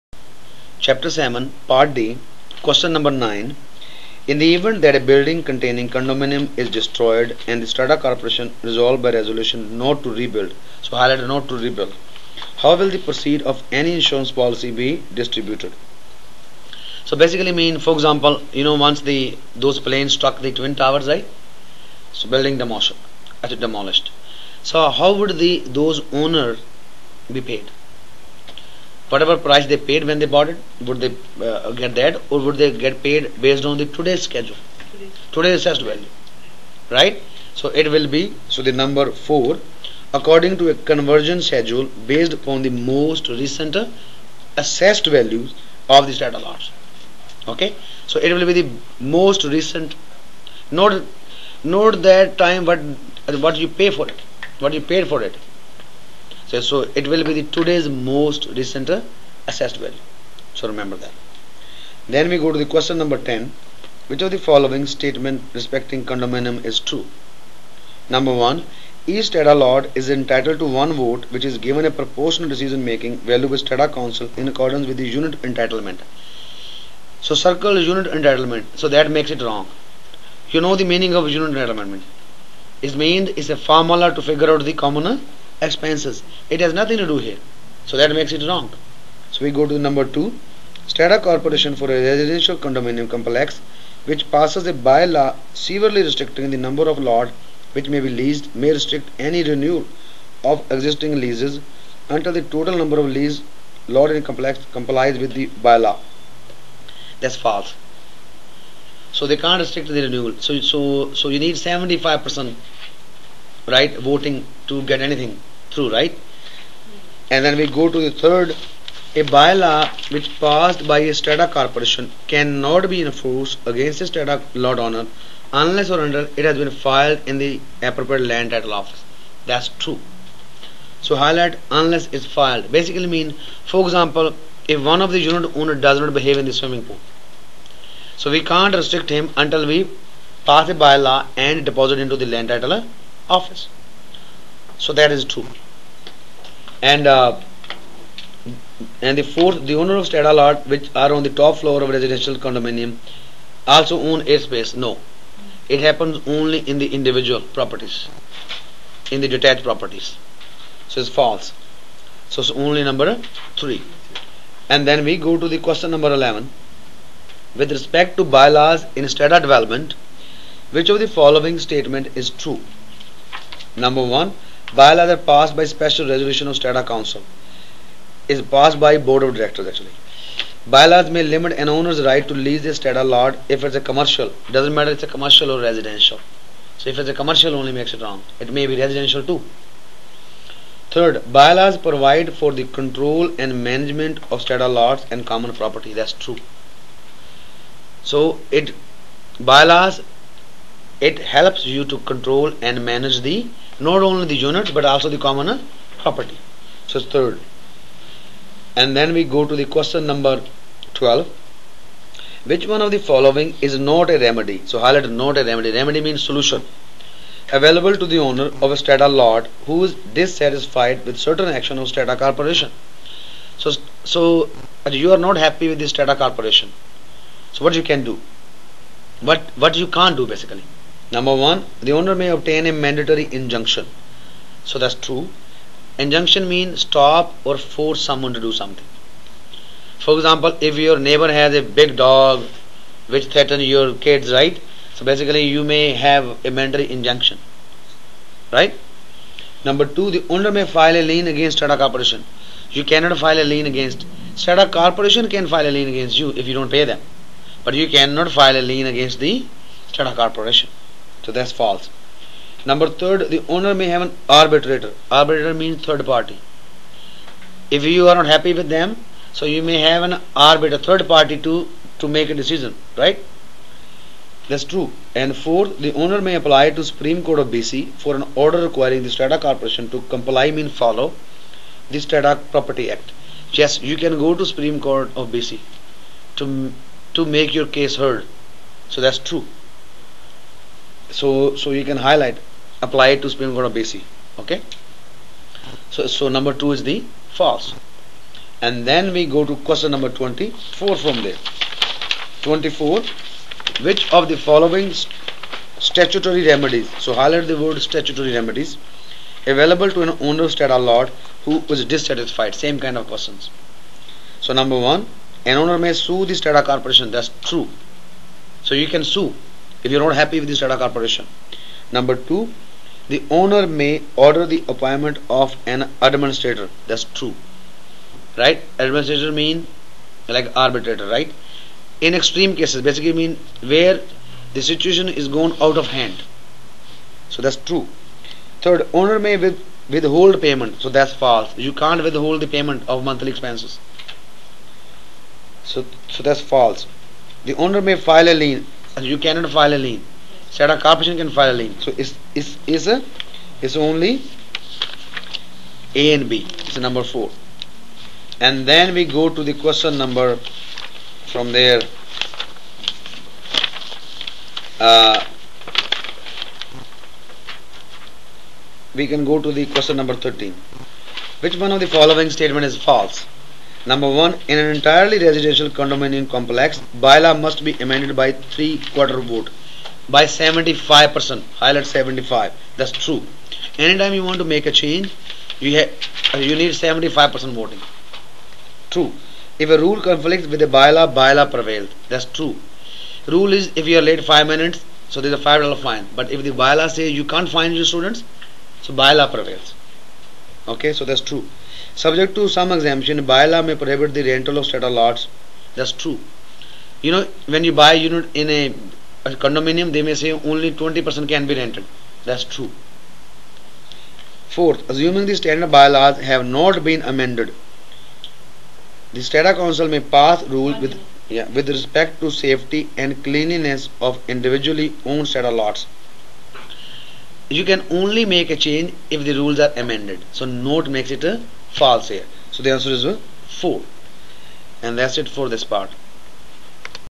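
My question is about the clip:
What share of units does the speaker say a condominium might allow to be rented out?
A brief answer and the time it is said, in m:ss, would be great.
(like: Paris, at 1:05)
20%, at 6:50.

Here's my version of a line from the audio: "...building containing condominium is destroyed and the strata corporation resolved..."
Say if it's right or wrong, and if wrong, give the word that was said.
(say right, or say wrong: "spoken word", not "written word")
right.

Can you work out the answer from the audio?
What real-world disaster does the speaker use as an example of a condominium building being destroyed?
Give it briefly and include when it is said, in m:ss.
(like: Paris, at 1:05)
Twin towers, at 0:20.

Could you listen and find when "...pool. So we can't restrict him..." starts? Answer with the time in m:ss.
2:16.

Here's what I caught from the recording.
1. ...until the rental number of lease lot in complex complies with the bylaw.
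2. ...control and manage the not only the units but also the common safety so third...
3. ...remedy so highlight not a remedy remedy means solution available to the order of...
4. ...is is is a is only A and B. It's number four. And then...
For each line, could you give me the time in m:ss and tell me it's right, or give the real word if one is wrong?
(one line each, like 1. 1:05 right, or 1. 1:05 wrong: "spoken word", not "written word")
1. 1:42 wrong: "total", not "rental"
2. 3:22 wrong: "property", not "safety"
3. 3:34 wrong: "owner", not "order"
4. 5:51 right.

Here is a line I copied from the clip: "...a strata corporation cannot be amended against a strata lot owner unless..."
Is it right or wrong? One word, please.
wrong.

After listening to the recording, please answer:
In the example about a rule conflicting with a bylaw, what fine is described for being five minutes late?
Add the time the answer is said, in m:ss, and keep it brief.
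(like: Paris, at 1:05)
$5, at 6:35.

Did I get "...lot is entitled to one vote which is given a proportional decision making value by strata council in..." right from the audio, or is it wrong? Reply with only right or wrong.
right.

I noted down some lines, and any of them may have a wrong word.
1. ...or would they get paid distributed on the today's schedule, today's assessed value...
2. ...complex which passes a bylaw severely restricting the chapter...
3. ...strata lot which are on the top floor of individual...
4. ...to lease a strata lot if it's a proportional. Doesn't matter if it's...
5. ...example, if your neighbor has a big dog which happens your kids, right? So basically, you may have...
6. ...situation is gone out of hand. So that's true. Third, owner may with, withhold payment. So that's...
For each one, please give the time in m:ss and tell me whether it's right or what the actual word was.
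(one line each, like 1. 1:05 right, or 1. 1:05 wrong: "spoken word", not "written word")
1. 0:32 wrong: "based", not "distributed"
2. 1:33 wrong: "number", not "chapter"
3. 2:30 wrong: "residential", not "individual"
4. 3:02 wrong: "commercial", not "proportional"
5. 4:00 wrong: "threatens", not "happens"
6. 5:34 right.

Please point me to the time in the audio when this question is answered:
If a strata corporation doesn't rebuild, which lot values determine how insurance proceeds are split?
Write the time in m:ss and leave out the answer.
0:42.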